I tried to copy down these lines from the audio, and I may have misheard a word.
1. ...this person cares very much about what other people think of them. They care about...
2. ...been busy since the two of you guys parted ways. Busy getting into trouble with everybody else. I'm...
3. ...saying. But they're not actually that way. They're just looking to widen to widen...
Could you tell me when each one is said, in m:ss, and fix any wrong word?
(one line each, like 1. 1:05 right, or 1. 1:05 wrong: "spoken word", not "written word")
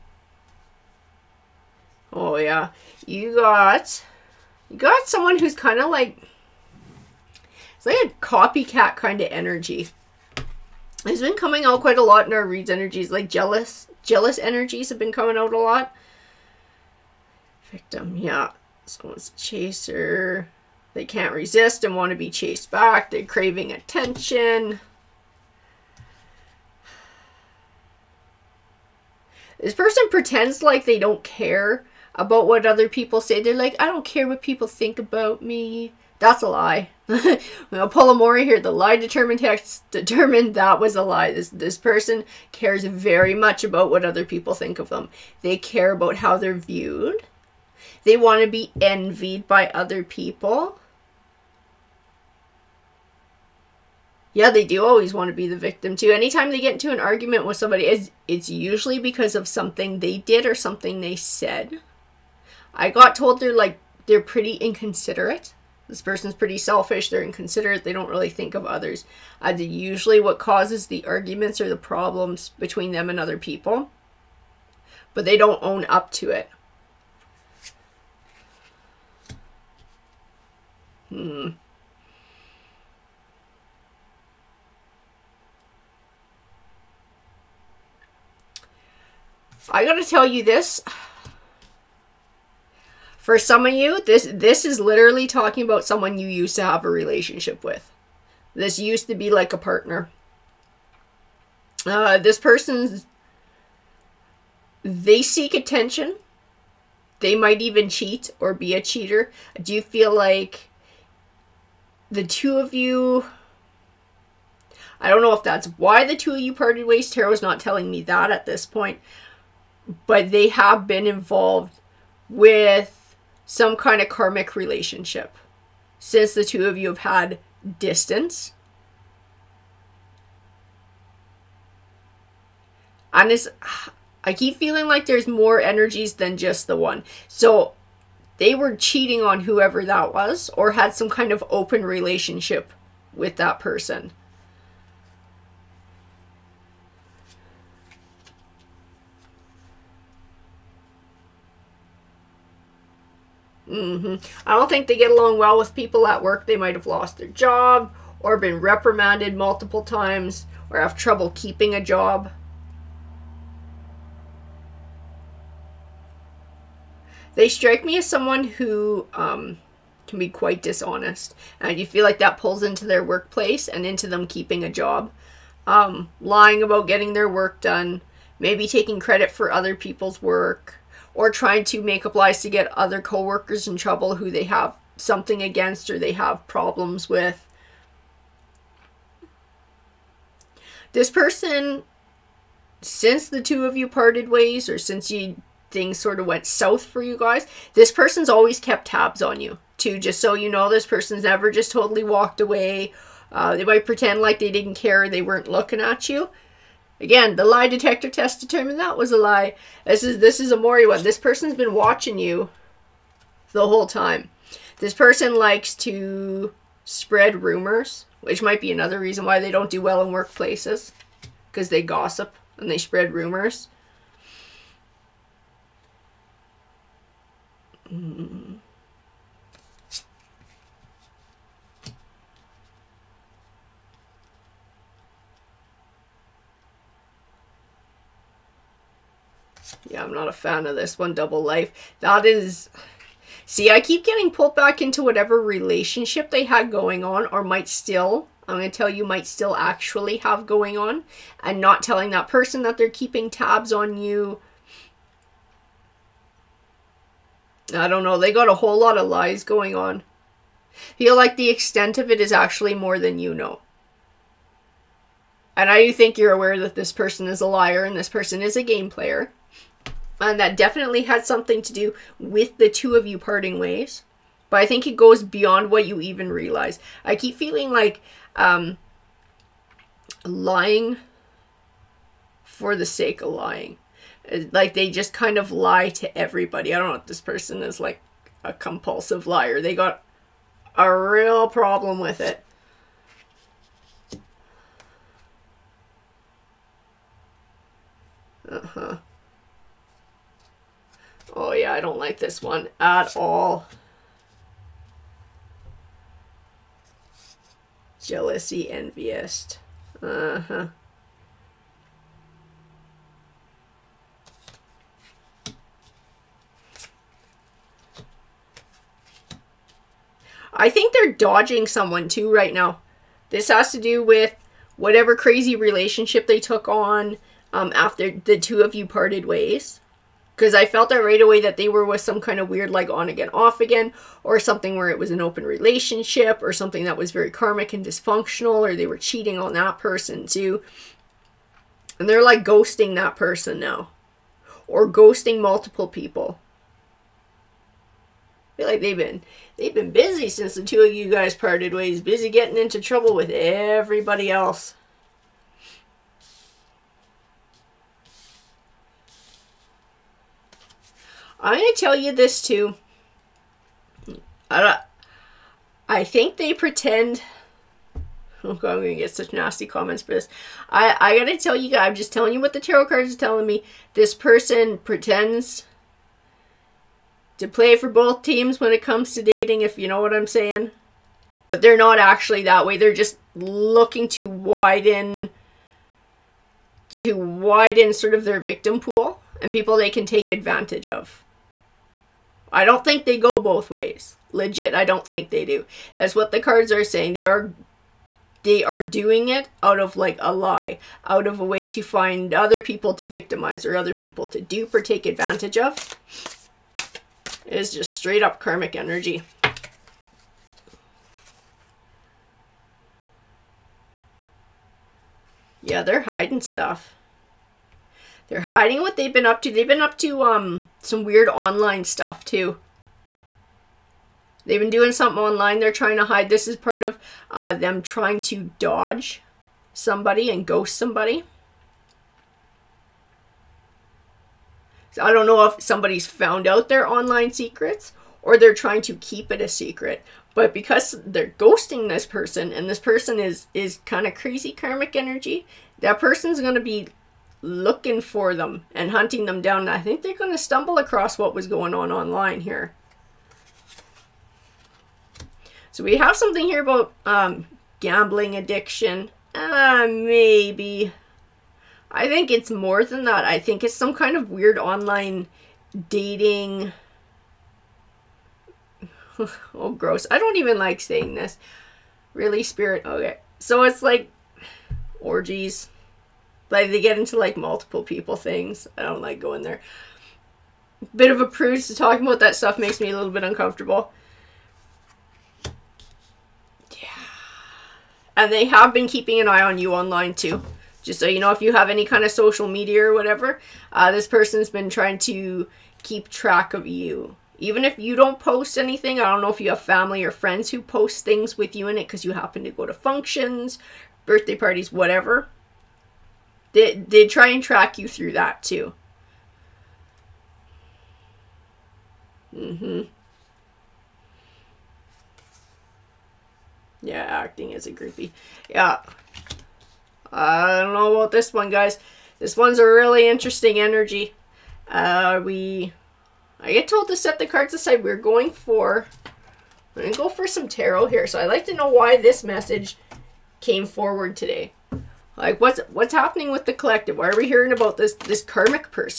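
1. 0:41 right
2. 5:49 right
3. 6:20 right.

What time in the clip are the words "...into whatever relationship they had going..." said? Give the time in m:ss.
4:04.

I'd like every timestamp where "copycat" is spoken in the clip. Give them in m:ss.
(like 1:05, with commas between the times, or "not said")
0:08.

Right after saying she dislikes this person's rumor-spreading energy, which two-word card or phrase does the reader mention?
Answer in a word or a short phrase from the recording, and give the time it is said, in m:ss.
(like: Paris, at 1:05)
Double Life, at 4:01.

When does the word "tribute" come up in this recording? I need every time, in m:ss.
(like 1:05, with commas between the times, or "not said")
not said.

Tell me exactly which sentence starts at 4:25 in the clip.
And I do think you're aware that this person is a liar and this person is a game player.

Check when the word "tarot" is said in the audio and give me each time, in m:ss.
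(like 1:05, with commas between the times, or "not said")
1:57, 6:12, 8:50.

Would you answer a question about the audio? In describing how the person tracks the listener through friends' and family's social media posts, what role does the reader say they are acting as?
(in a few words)
groupie.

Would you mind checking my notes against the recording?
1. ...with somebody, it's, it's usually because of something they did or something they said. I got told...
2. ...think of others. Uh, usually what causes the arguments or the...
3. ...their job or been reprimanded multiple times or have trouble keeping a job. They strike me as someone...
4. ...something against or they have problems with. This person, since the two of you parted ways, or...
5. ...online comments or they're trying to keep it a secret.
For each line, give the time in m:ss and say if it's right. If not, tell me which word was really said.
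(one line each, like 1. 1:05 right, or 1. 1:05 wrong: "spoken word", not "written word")
1. 0:57 right
2. 1:08 right
3. 2:37 right
4. 3:04 right
5. 7:16 wrong: "secrets", not "comments".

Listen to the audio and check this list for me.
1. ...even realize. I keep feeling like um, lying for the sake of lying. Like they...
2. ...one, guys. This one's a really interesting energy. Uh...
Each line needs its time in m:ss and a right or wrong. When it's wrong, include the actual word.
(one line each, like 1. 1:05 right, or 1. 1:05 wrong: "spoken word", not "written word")
1. 4:36 right
2. 8:41 right.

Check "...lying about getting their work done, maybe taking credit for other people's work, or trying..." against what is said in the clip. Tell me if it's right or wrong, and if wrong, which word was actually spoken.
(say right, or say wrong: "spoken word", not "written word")
right.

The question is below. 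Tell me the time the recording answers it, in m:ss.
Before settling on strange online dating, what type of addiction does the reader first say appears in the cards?
7:37.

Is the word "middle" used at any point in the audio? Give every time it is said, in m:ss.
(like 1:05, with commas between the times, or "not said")
not said.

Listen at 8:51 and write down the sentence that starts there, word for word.
So I'd like to know why this message came forward today.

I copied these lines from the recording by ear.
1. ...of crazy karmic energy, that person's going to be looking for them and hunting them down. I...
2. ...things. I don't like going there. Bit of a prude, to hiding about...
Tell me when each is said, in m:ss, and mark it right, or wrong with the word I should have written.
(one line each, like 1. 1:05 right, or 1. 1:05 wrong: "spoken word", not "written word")
1. 7:24 right
2. 7:58 wrong: "talking", not "hiding".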